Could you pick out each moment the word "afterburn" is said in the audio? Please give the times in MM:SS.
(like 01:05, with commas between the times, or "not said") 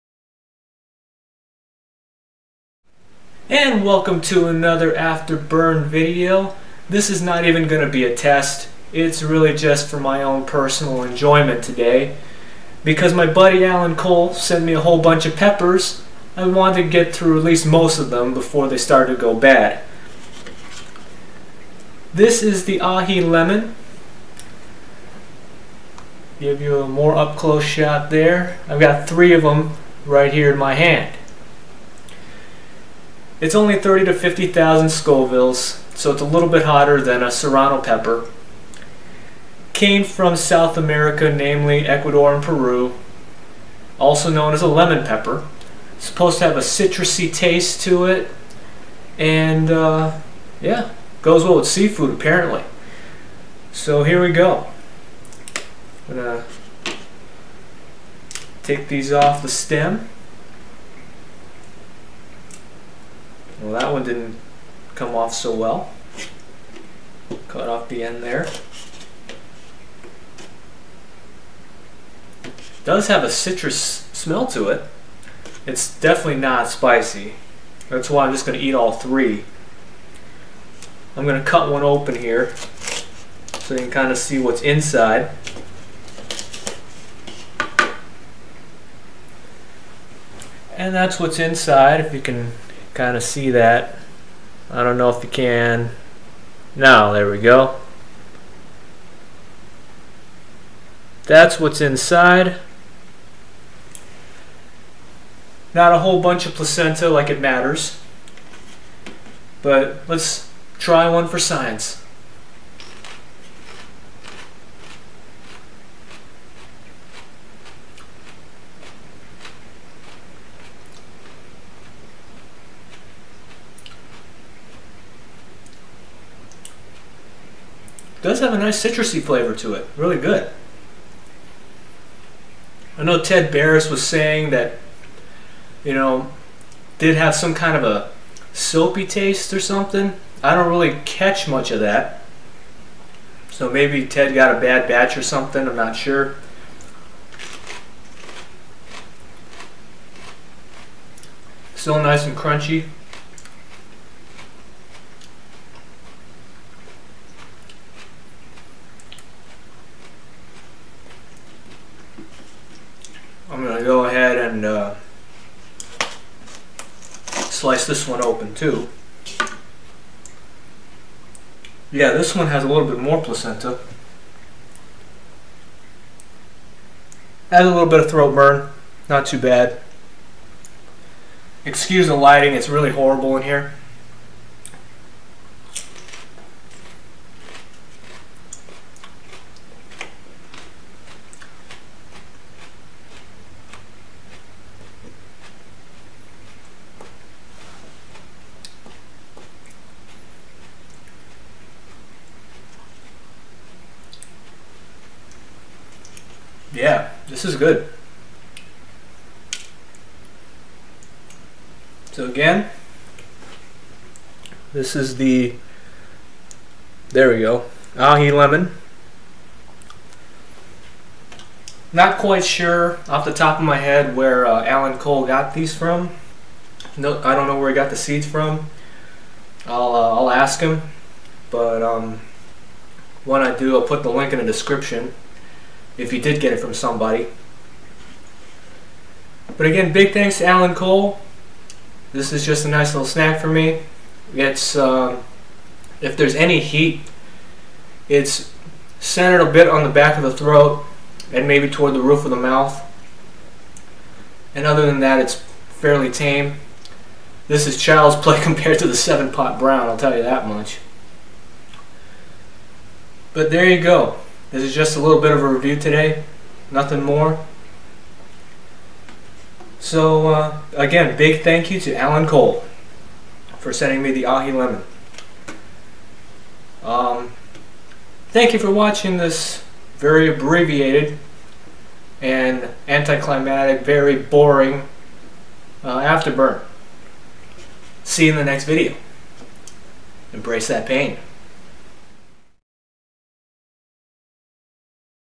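00:04, 04:45.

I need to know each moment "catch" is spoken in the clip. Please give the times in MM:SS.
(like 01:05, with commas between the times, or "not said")
02:21.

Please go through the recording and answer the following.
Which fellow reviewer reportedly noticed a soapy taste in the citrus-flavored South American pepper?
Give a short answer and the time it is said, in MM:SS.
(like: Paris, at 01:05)
Ted Barris, at 02:13.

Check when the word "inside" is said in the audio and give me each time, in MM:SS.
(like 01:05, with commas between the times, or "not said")
01:24, 01:31, 01:41.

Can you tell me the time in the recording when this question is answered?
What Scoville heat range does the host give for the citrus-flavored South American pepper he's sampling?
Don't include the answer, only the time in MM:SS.
00:33.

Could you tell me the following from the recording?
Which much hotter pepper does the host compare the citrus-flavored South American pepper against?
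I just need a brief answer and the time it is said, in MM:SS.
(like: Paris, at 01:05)
seven pot brown, at 04:18.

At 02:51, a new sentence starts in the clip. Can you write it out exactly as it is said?
Yeah, this one has a little bit more placenta.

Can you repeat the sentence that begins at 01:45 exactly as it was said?
Not a whole bunch of placenta like it matters, but let's try one for science.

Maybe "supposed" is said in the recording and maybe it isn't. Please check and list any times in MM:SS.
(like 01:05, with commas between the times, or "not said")
00:46.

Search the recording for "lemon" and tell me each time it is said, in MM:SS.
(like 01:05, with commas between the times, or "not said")
00:23, 00:44, 03:38, 04:34.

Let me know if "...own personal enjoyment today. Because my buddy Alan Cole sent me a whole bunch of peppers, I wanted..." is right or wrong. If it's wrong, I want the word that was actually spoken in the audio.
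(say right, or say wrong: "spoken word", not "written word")
right.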